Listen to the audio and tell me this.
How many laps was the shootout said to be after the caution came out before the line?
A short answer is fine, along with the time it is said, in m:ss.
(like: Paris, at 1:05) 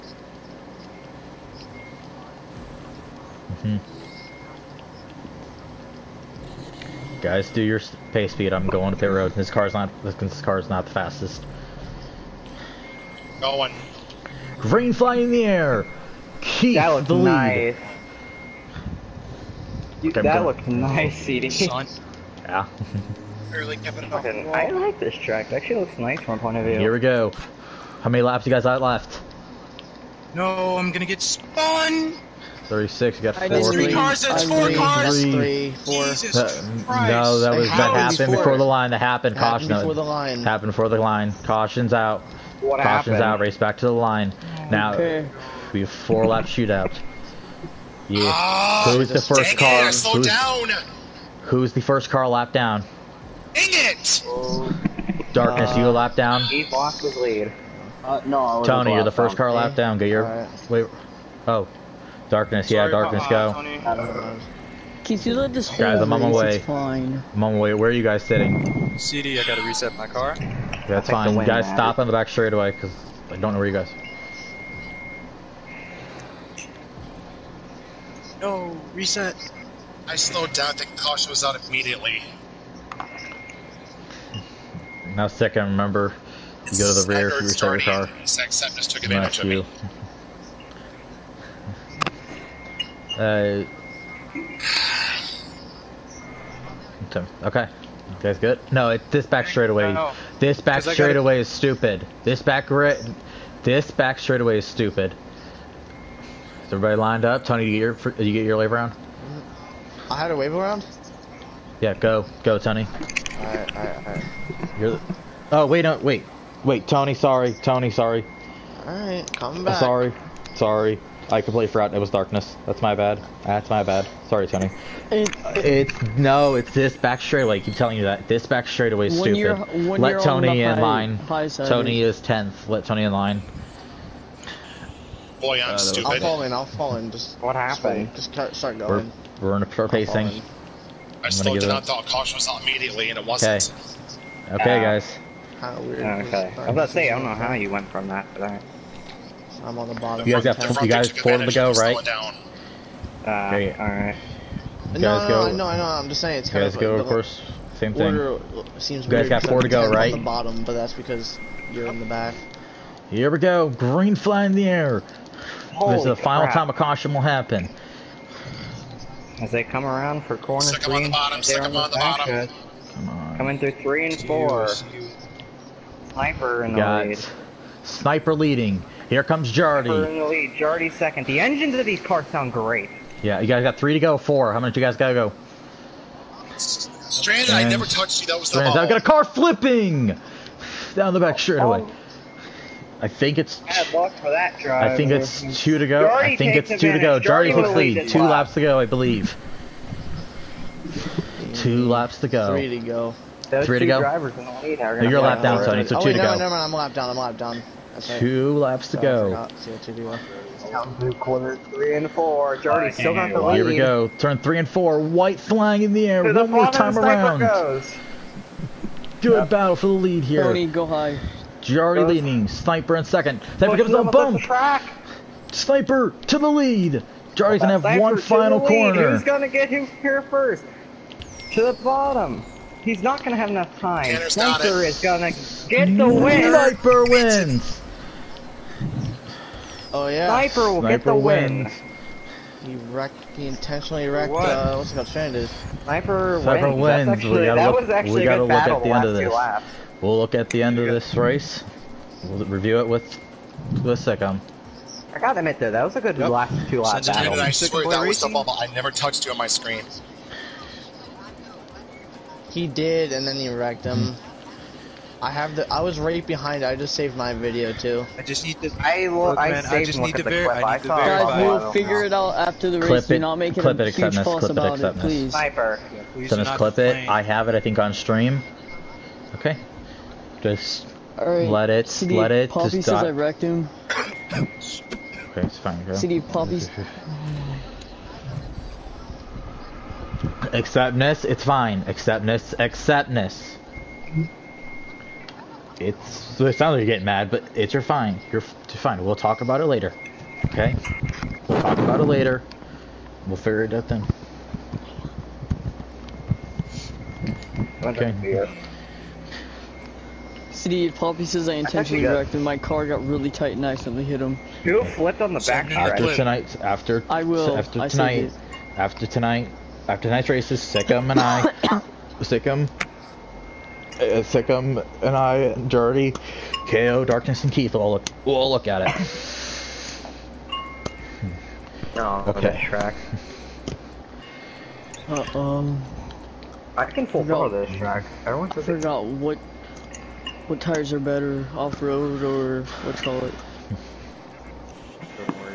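4, at 0:45.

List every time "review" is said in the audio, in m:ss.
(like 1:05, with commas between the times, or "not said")
4:12.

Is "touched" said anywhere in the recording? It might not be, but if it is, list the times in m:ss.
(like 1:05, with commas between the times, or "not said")
3:07, 4:18.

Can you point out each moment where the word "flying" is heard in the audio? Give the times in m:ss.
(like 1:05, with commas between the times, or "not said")
0:14, 3:35.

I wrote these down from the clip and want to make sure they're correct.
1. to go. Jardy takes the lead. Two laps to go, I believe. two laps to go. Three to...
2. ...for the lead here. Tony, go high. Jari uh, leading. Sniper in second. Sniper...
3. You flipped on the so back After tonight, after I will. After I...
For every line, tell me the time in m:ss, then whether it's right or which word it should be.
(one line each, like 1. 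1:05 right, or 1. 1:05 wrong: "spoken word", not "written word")
1. 3:16 right
2. 3:39 right
3. 5:14 right.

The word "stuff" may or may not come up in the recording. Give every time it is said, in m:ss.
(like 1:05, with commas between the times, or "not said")
4:18.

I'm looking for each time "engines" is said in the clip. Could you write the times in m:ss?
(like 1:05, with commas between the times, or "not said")
3:01.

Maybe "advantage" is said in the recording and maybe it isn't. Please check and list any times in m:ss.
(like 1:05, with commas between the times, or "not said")
1:29, 3:16.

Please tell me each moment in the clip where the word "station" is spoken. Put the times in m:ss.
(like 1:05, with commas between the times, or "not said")
not said.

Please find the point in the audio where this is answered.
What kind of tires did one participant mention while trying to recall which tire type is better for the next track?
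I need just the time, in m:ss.
5:41.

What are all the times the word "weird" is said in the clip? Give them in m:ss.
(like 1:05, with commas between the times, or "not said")
2:25.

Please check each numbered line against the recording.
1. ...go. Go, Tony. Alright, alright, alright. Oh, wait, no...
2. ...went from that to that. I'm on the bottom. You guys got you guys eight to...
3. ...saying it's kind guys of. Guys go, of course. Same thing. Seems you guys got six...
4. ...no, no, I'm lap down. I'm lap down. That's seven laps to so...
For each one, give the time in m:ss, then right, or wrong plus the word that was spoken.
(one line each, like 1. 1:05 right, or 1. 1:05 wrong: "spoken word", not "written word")
1. 1:51 right
2. 2:27 wrong: "four", not "eight"
3. 2:36 wrong: "four", not "six"
4. 3:26 wrong: "two", not "seven".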